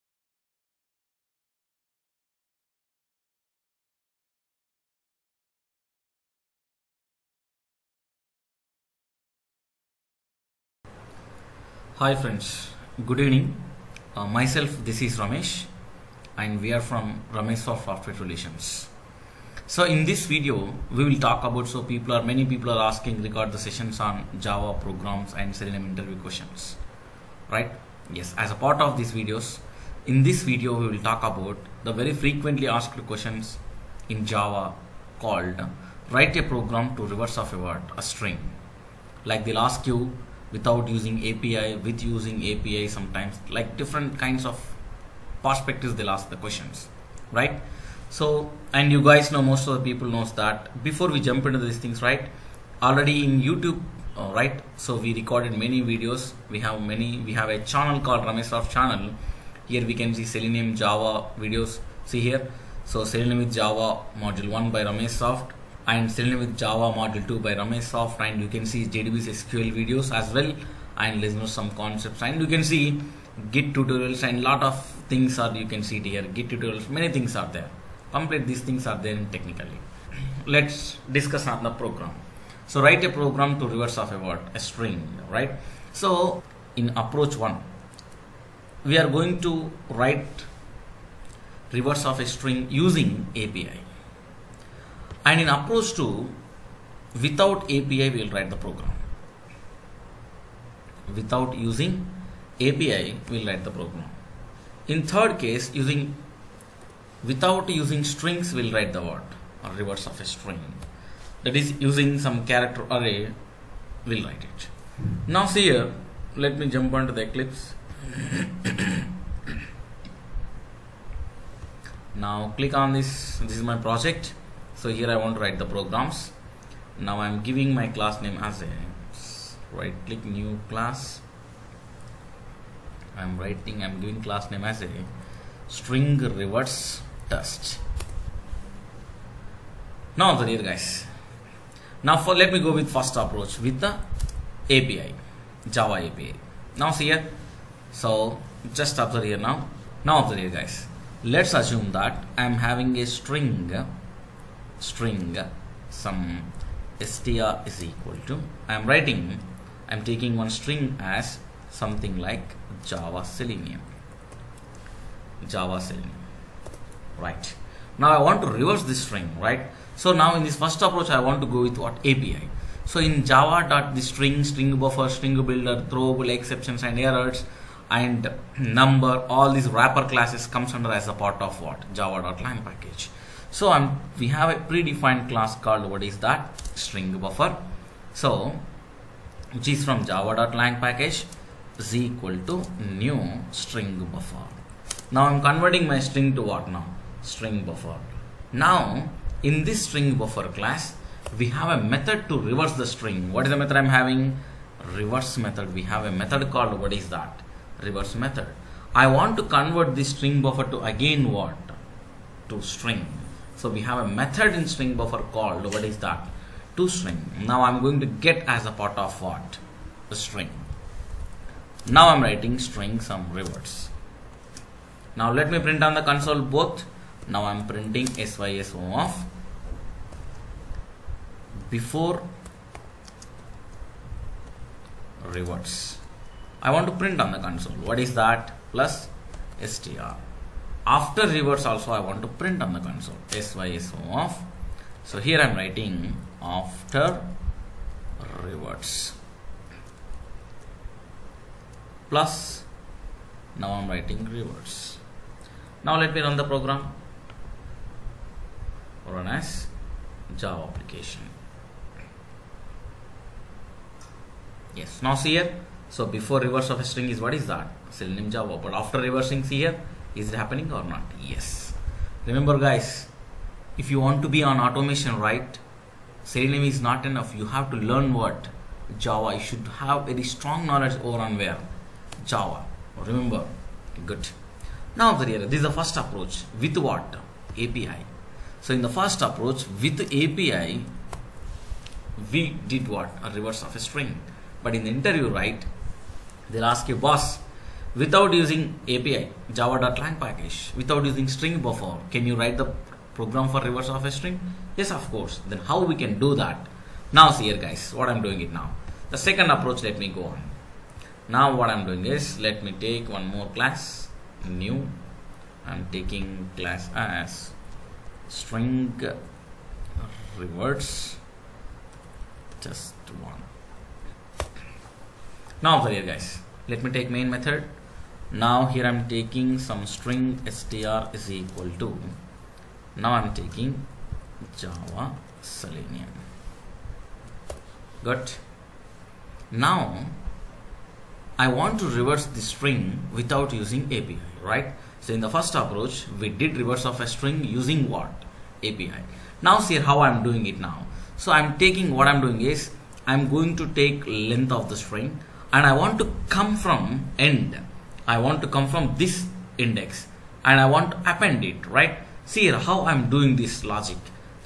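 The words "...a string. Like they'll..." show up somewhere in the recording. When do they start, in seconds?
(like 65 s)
37 s.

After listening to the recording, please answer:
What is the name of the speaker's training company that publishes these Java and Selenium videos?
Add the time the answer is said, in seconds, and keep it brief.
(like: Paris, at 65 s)
Ramesh Soft Software Relations, at 17 s.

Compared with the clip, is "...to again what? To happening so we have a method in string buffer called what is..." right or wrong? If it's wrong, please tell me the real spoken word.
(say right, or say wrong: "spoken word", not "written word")
wrong: "string", not "happening".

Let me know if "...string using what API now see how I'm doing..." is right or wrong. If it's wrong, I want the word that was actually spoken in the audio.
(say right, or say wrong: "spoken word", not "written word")
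right.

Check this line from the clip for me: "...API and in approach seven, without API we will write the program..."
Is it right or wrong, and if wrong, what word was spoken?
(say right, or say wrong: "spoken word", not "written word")
wrong: "two", not "seven".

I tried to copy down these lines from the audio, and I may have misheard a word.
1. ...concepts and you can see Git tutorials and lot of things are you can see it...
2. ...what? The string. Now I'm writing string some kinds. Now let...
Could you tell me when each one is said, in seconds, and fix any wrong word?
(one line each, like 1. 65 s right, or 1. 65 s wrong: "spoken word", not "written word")
1. 71 s right
2. 219 s wrong: "rewards", not "kinds".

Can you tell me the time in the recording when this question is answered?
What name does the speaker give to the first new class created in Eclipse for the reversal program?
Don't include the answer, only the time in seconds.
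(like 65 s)
135 s.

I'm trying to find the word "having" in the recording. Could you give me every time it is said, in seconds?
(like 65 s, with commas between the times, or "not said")
152 s, 203 s.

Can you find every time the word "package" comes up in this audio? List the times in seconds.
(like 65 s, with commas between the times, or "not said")
182 s, 190 s, 300 s.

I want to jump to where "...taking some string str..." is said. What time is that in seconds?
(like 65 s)
329 s.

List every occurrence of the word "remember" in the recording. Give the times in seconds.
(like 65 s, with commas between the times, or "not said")
272 s, 283 s.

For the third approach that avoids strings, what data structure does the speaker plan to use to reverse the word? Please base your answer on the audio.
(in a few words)
character array.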